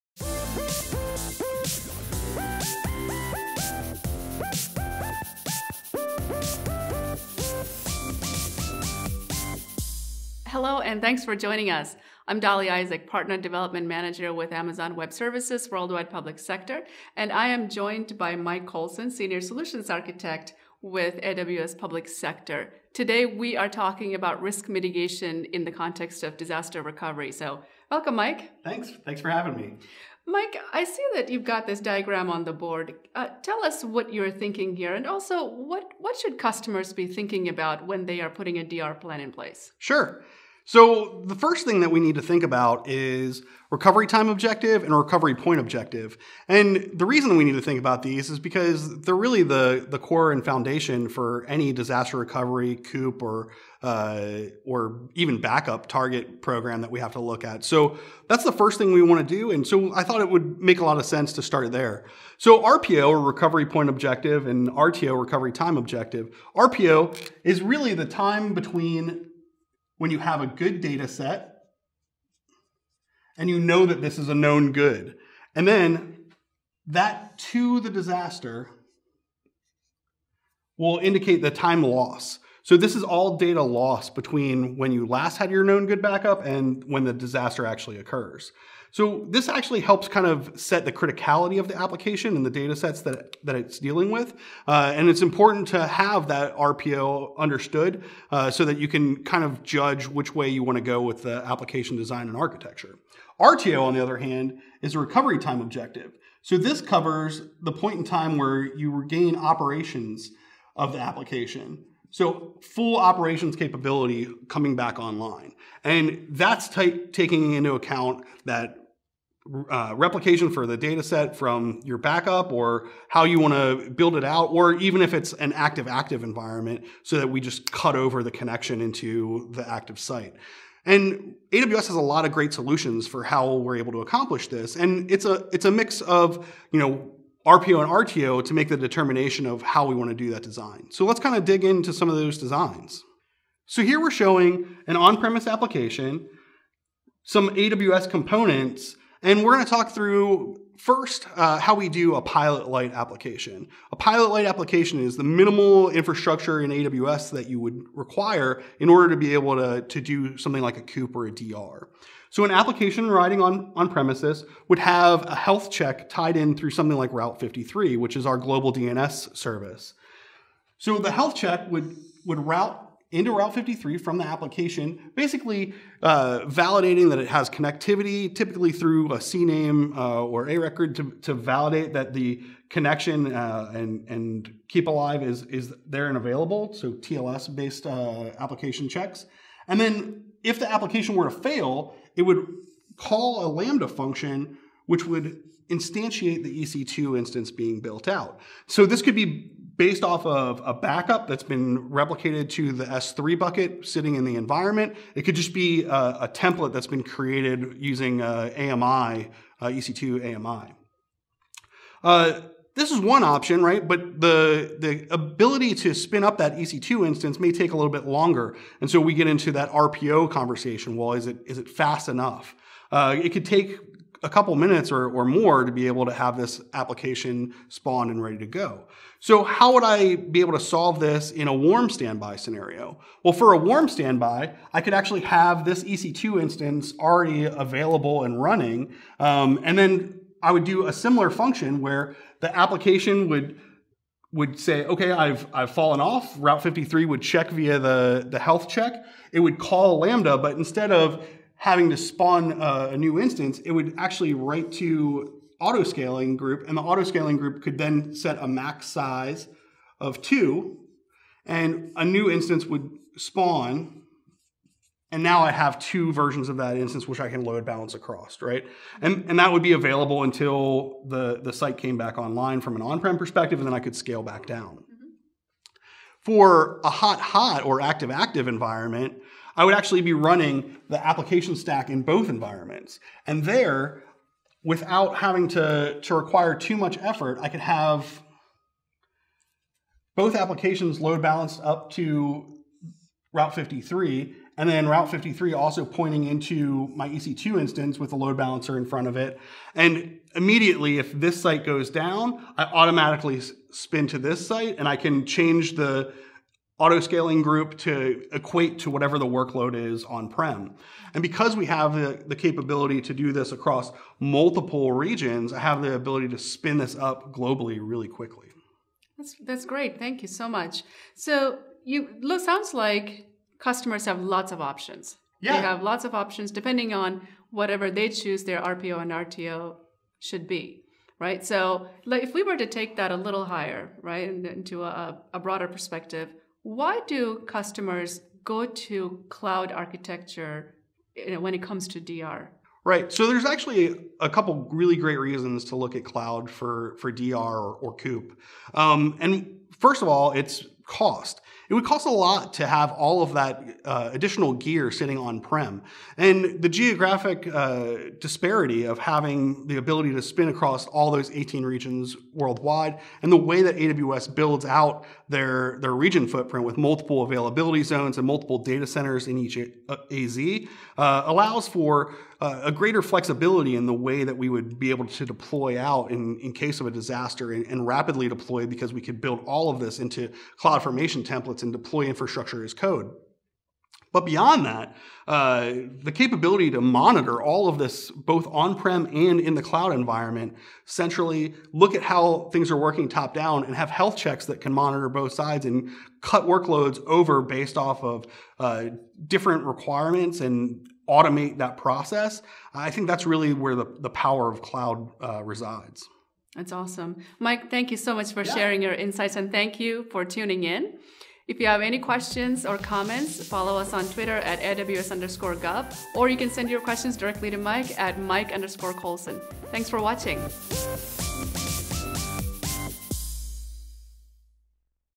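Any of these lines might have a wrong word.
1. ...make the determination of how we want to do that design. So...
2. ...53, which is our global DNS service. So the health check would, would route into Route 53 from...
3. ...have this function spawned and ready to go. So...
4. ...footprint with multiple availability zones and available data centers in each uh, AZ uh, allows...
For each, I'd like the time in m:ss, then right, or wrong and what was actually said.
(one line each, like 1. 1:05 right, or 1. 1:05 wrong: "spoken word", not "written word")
1. 2:18 right
2. 2:47 right
3. 3:46 wrong: "application", not "function"
4. 6:06 wrong: "multiple", not "available".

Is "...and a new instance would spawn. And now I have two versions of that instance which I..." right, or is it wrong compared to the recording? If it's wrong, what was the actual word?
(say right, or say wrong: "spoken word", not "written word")
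right.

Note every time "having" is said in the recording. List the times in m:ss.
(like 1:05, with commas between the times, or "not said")
0:29, 4:11, 4:45, 5:58.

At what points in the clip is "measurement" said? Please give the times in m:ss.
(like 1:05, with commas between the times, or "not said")
not said.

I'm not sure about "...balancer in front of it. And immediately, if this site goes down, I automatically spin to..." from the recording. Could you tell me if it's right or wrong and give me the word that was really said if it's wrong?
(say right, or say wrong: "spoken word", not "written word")
right.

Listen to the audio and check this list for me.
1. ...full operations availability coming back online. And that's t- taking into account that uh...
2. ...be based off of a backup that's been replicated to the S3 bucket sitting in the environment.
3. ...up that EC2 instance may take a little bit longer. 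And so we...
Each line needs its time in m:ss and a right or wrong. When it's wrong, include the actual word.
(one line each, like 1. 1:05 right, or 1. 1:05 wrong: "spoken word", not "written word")
1. 1:52 wrong: "capability", not "availability"
2. 3:19 right
3. 3:36 right.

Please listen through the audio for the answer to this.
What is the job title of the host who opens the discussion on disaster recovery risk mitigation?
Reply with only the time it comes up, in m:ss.
0:13.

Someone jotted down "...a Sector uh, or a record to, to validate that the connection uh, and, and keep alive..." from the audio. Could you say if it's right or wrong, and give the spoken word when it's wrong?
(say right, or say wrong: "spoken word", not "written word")
wrong: "CNAME", not "Sector".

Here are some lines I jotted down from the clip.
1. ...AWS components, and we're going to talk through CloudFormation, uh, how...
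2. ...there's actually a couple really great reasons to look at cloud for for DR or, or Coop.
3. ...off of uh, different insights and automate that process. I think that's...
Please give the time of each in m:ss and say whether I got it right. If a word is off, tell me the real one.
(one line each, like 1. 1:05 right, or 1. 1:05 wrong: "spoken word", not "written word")
1. 2:27 wrong: "First", not "CloudFormation"
2. 5:43 right
3. 6:37 wrong: "requirements", not "insights".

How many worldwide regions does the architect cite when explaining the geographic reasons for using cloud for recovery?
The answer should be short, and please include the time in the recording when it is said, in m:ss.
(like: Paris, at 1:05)
18, at 6:01.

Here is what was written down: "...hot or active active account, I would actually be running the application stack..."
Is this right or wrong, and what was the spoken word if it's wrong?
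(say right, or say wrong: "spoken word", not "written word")
wrong: "environment", not "account".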